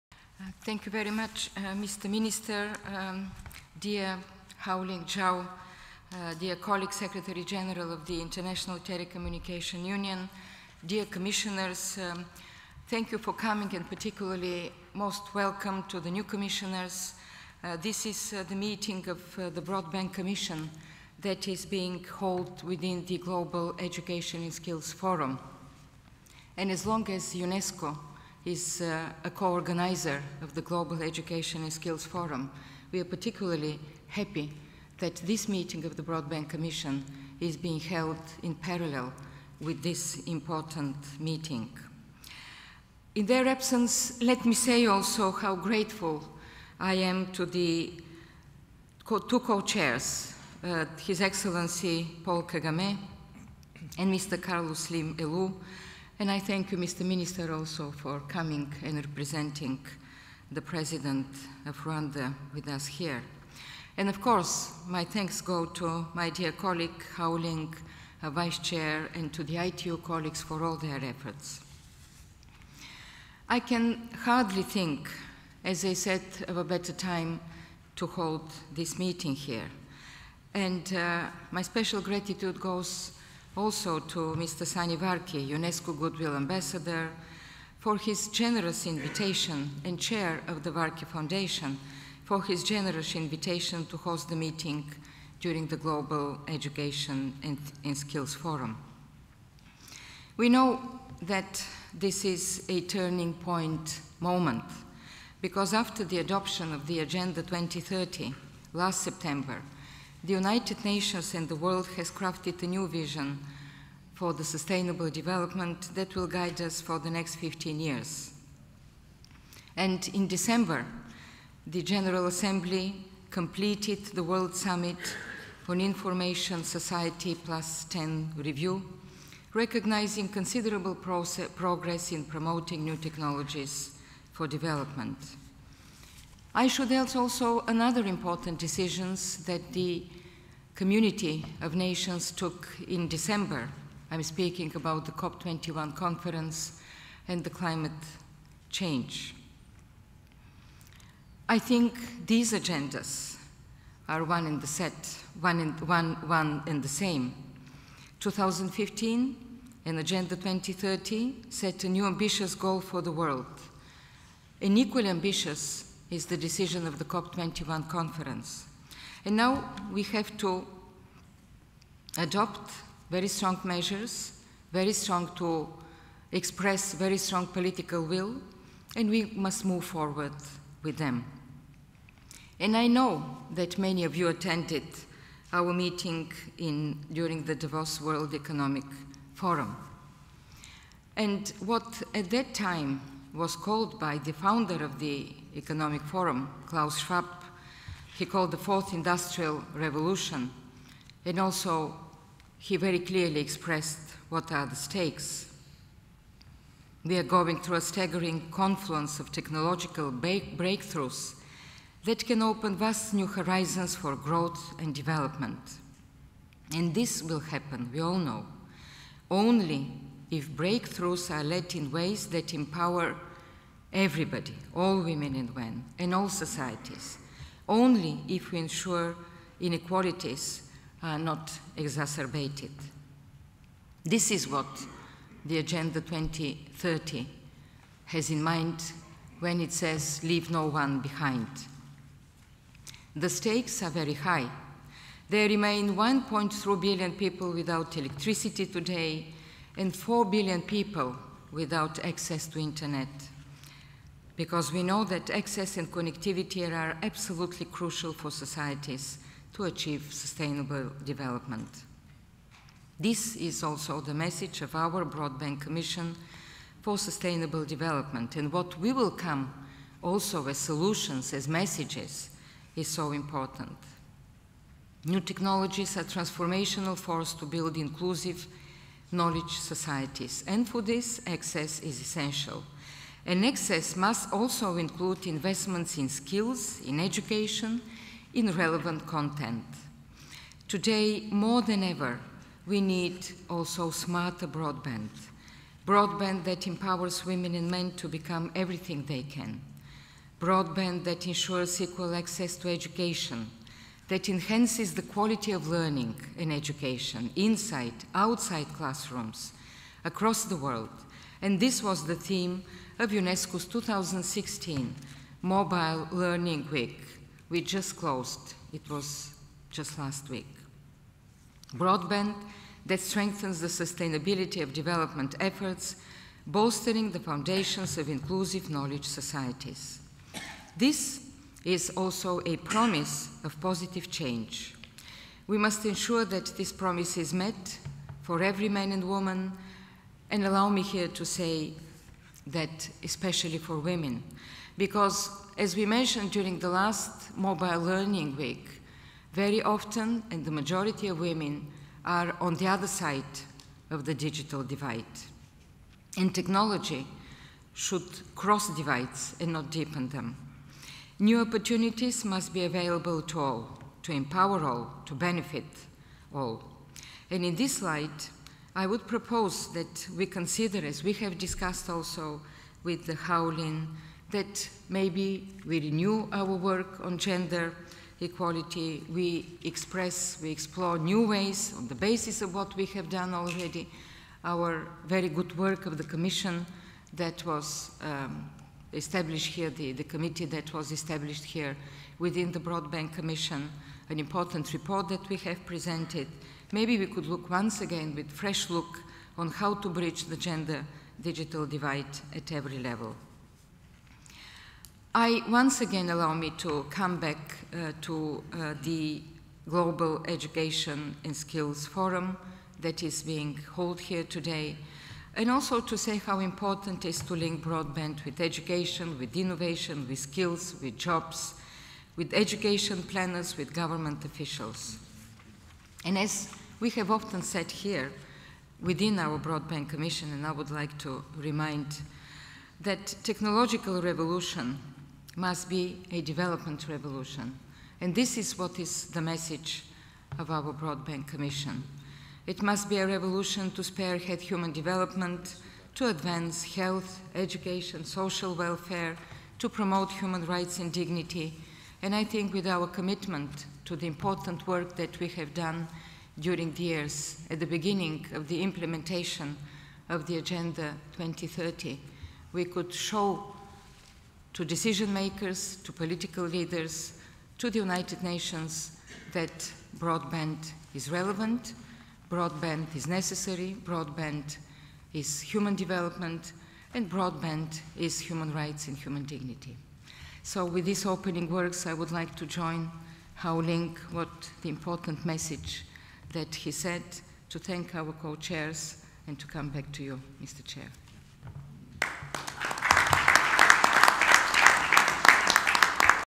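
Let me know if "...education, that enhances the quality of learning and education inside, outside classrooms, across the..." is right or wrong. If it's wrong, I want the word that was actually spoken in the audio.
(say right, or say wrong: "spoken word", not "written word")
right.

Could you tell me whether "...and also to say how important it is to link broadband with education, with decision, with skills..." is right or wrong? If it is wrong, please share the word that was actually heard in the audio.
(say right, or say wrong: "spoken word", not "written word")
wrong: "innovation", not "decision".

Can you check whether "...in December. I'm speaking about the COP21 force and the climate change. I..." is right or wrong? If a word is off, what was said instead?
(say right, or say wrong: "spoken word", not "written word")
wrong: "conference", not "force".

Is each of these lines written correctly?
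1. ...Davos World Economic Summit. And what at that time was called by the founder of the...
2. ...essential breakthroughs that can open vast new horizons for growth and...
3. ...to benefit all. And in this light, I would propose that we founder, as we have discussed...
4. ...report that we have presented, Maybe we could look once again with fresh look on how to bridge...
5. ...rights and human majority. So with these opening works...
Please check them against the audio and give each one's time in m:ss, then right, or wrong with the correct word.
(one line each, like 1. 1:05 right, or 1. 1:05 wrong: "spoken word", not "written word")
1. 3:07 wrong: "Forum", not "Summit"
2. 3:29 wrong: "technological", not "essential"
3. 6:05 wrong: "consider", not "founder"
4. 6:34 right
5. 7:58 wrong: "dignity", not "majority".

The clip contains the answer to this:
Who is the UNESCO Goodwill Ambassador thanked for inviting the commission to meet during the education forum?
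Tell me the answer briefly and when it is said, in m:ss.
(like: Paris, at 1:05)
Sunny Varkey, at 1:24.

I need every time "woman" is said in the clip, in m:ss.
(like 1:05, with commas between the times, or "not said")
5:39.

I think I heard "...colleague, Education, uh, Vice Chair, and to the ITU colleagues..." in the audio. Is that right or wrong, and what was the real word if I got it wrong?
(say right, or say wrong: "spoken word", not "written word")
wrong: "Houlin", not "Education".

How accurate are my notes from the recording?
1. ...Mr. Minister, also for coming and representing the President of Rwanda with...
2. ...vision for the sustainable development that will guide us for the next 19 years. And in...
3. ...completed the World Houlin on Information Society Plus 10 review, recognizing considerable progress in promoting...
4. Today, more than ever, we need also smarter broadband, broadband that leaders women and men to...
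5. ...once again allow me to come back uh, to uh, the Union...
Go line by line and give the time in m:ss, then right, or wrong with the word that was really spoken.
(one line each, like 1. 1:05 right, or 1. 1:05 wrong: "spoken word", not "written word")
1. 0:56 right
2. 1:52 wrong: "15", not "19"
3. 2:03 wrong: "Summit", not "Houlin"
4. 4:50 wrong: "empowers", not "leaders"
5. 6:45 wrong: "Global", not "Union".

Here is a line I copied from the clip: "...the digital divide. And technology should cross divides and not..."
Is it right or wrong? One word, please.
right.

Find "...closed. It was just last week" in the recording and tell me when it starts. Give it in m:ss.
5:17.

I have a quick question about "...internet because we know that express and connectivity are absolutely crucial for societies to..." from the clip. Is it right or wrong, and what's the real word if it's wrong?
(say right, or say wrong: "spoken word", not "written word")
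wrong: "access", not "express".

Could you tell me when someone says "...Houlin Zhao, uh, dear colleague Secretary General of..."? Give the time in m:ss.
0:04.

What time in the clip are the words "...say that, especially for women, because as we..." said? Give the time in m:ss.
5:41.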